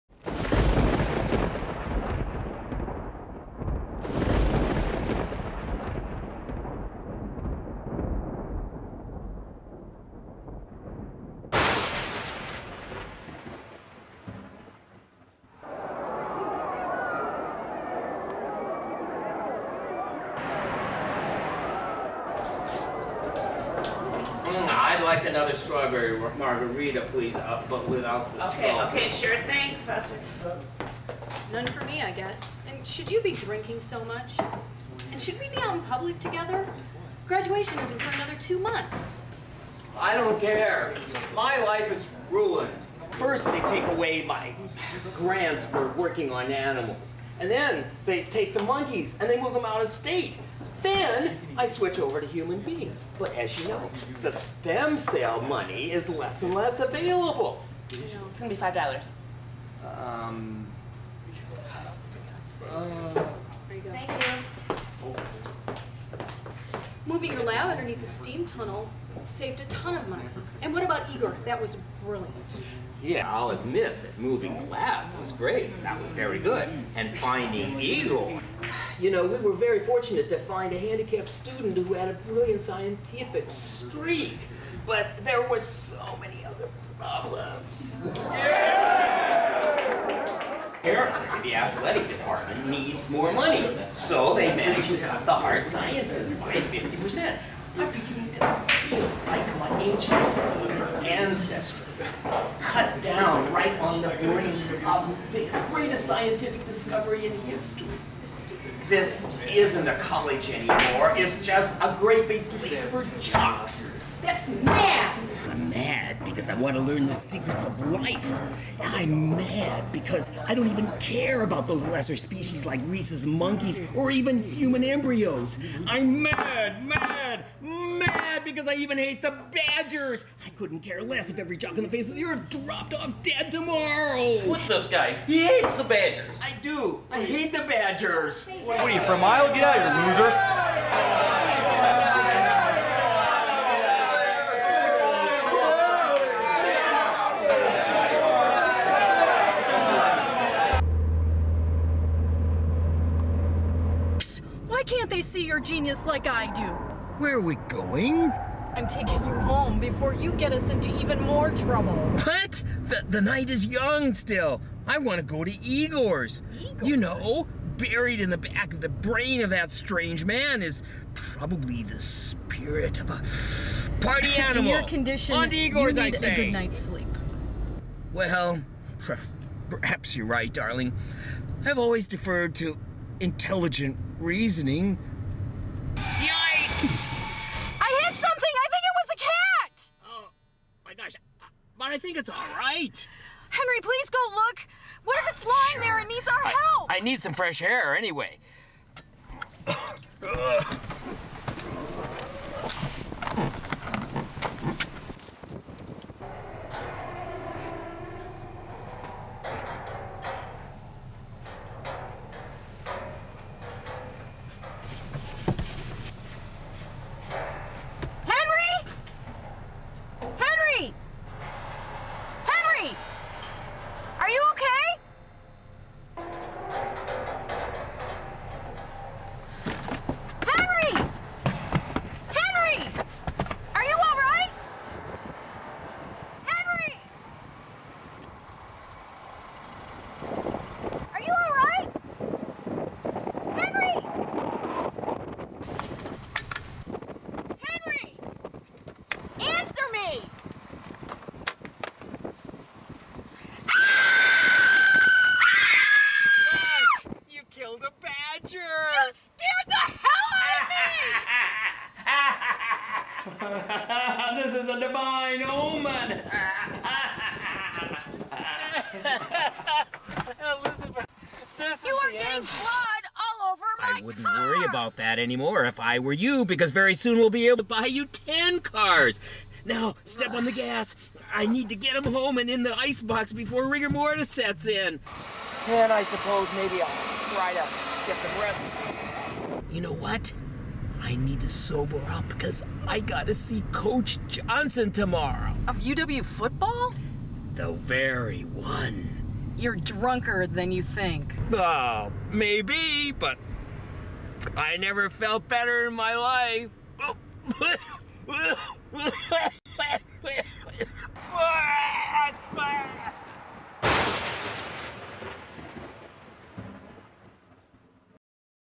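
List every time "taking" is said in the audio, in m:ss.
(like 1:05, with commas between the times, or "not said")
2:38.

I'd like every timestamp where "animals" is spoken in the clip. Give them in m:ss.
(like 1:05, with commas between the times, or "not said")
0:46, 2:54.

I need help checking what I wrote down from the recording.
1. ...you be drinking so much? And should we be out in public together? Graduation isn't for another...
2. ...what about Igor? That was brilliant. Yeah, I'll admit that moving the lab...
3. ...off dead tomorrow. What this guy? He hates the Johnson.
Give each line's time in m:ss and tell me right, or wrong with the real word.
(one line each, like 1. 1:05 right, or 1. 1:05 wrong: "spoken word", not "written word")
1. 0:33 right
2. 1:10 right
3. 2:12 wrong: "Badgers", not "Johnson".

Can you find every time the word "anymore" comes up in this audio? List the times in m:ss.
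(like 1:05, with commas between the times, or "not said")
1:50, 4:35.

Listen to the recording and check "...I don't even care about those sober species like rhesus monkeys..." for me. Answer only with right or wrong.
wrong.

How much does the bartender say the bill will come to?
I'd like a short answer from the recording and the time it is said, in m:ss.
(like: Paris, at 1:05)
$5, at 0:58.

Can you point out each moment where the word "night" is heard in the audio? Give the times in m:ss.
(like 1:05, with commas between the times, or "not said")
2:43, 2:56.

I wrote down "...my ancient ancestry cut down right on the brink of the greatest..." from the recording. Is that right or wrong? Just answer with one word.
right.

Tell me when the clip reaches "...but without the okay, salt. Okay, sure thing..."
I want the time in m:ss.
0:27.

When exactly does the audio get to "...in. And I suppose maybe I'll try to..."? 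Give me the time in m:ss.
4:44.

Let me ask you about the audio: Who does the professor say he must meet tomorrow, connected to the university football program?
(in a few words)
Coach Johnson.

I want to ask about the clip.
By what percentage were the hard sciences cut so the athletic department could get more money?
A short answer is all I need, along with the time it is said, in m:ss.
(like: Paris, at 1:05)
50%, at 1:36.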